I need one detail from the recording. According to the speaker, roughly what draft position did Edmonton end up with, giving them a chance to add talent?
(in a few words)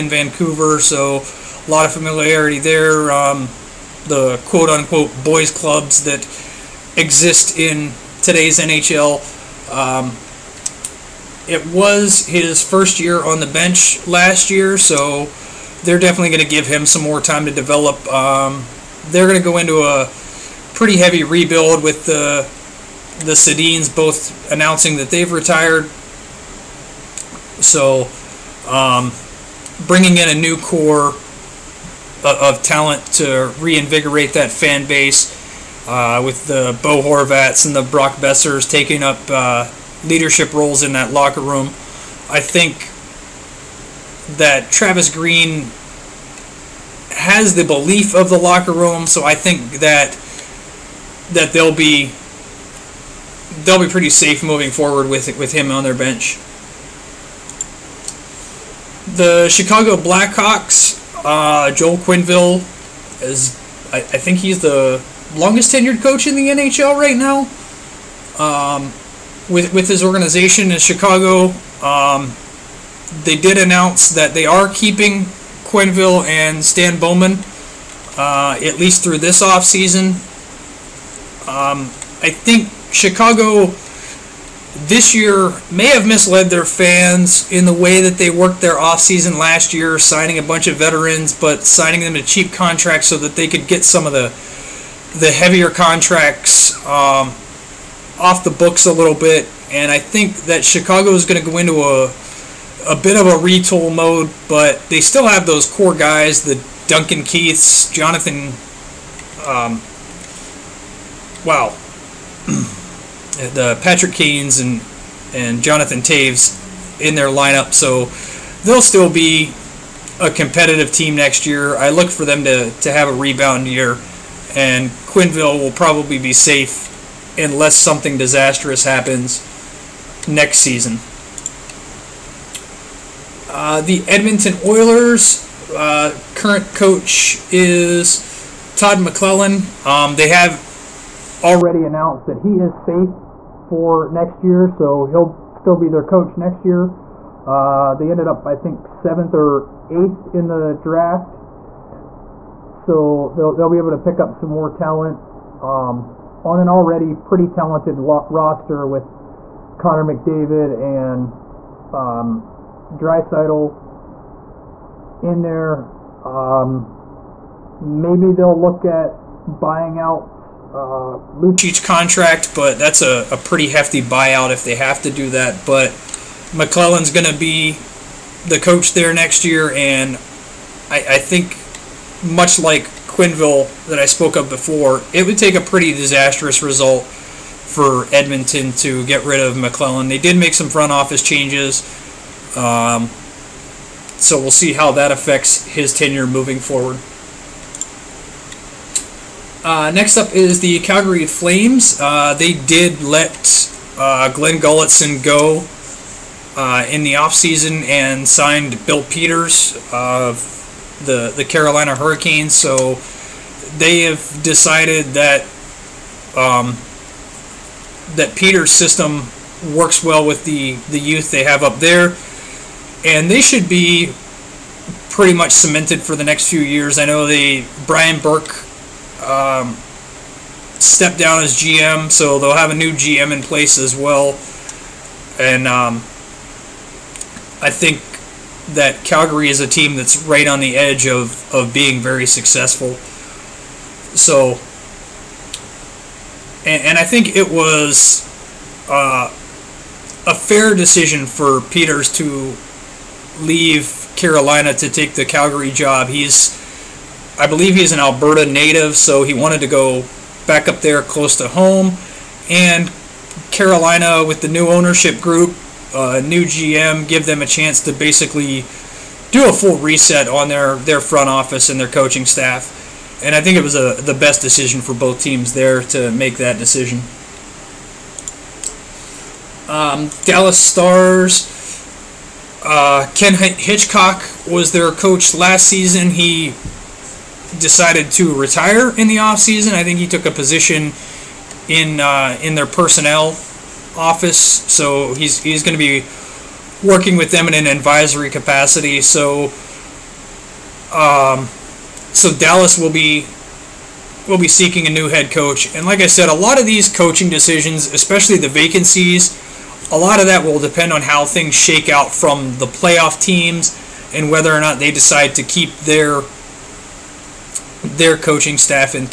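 7th or 8th.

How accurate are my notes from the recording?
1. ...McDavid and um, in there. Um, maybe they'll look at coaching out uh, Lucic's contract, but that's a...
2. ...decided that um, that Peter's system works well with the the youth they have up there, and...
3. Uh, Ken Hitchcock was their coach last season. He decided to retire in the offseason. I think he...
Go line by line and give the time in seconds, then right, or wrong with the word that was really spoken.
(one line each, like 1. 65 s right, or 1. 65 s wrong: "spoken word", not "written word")
1. 160 s wrong: "buying", not "coaching"
2. 214 s right
3. 282 s right.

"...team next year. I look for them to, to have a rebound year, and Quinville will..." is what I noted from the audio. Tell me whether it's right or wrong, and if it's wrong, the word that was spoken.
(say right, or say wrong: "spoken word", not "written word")
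right.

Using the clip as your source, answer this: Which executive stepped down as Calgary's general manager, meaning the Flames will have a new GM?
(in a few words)
Brian Burke.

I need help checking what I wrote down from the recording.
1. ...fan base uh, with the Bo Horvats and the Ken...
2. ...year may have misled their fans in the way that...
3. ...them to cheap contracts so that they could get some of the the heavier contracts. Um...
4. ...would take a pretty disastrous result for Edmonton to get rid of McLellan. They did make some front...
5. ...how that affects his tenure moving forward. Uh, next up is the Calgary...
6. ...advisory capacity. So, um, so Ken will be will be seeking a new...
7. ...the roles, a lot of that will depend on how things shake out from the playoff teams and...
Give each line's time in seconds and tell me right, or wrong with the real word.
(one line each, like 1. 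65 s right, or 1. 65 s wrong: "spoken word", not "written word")
1. 34 s wrong: "Brock", not "Ken"
2. 85 s right
3. 92 s right
4. 185 s right
5. 194 s right
6. 297 s wrong: "Dallas", not "Ken"
7. 308 s wrong: "vacancies", not "roles".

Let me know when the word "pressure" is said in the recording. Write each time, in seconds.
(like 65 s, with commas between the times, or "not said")
not said.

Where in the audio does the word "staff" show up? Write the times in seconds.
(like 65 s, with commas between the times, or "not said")
272 s, 318 s.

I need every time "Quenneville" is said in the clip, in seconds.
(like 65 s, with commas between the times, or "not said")
61 s, 75 s, 183 s.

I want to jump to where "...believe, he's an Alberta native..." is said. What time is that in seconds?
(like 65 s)
257 s.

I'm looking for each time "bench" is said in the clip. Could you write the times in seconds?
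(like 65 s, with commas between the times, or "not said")
13 s, 55 s.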